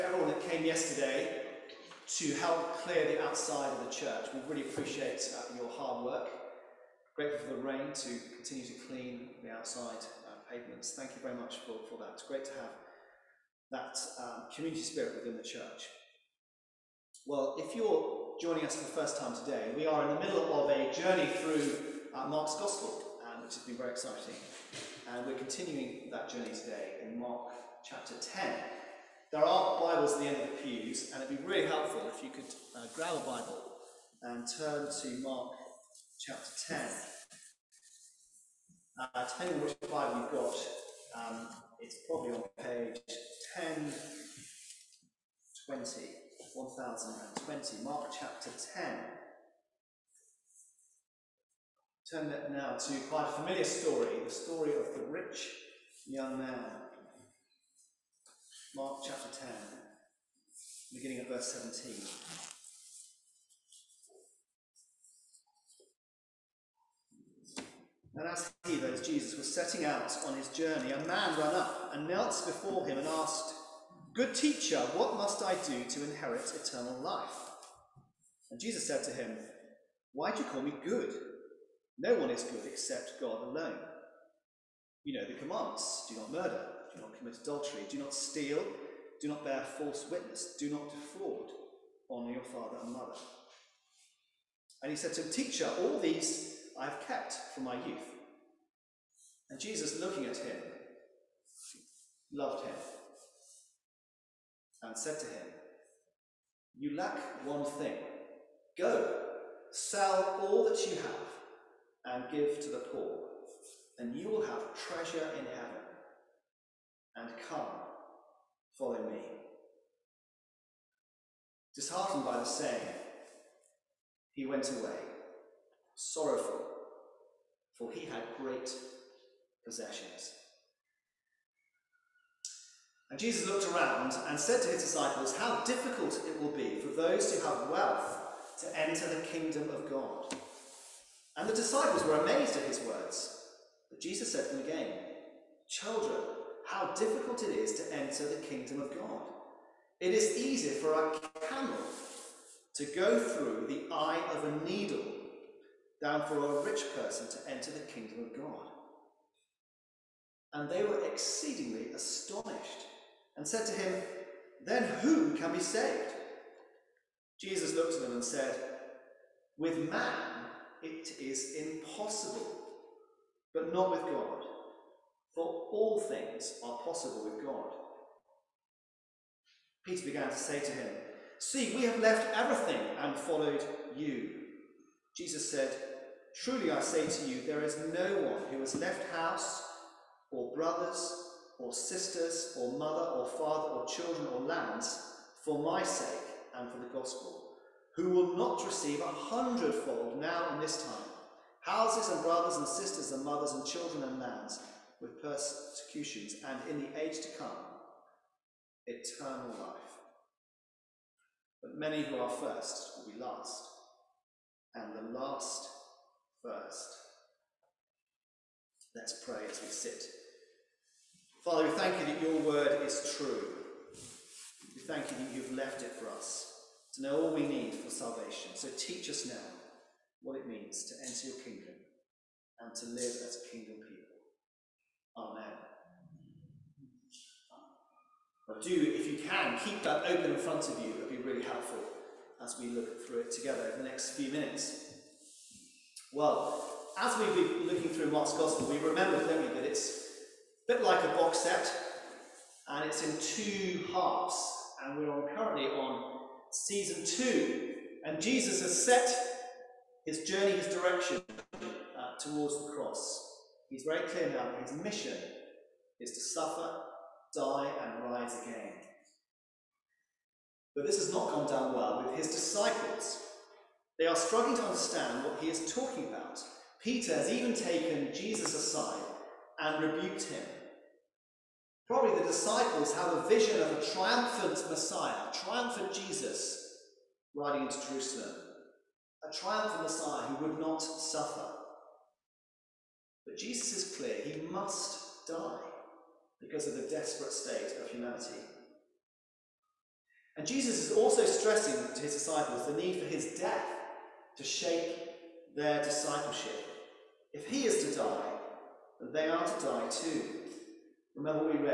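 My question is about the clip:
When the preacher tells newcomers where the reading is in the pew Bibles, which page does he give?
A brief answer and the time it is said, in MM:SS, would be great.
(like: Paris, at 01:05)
1020, at 00:46.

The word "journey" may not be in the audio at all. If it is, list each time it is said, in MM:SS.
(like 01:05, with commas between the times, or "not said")
00:20, 00:26, 01:10, 04:20.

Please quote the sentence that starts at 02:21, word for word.
And the disciples were amazed at his words.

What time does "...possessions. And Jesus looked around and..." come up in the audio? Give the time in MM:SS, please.
02:09.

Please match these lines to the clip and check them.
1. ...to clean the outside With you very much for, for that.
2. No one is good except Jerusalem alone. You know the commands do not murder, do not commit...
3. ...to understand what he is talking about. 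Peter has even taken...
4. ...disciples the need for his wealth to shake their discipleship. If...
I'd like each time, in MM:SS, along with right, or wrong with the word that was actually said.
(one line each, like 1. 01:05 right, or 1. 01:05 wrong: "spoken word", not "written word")
1. 00:08 wrong: "Thank", not "With"
2. 01:21 wrong: "God", not "Jerusalem"
3. 04:34 right
4. 05:02 wrong: "death", not "wealth".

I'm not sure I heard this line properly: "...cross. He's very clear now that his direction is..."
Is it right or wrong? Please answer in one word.
wrong.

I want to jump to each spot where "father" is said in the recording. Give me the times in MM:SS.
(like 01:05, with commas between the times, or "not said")
01:32, 03:13, 03:41.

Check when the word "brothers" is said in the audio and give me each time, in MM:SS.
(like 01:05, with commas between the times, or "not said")
03:10, 03:22.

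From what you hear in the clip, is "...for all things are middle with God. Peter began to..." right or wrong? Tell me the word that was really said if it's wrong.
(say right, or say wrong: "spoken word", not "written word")
wrong: "possible", not "middle".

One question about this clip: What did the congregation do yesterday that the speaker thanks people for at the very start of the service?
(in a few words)
clear the outside of the church.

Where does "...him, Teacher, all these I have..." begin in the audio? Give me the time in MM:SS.
01:35.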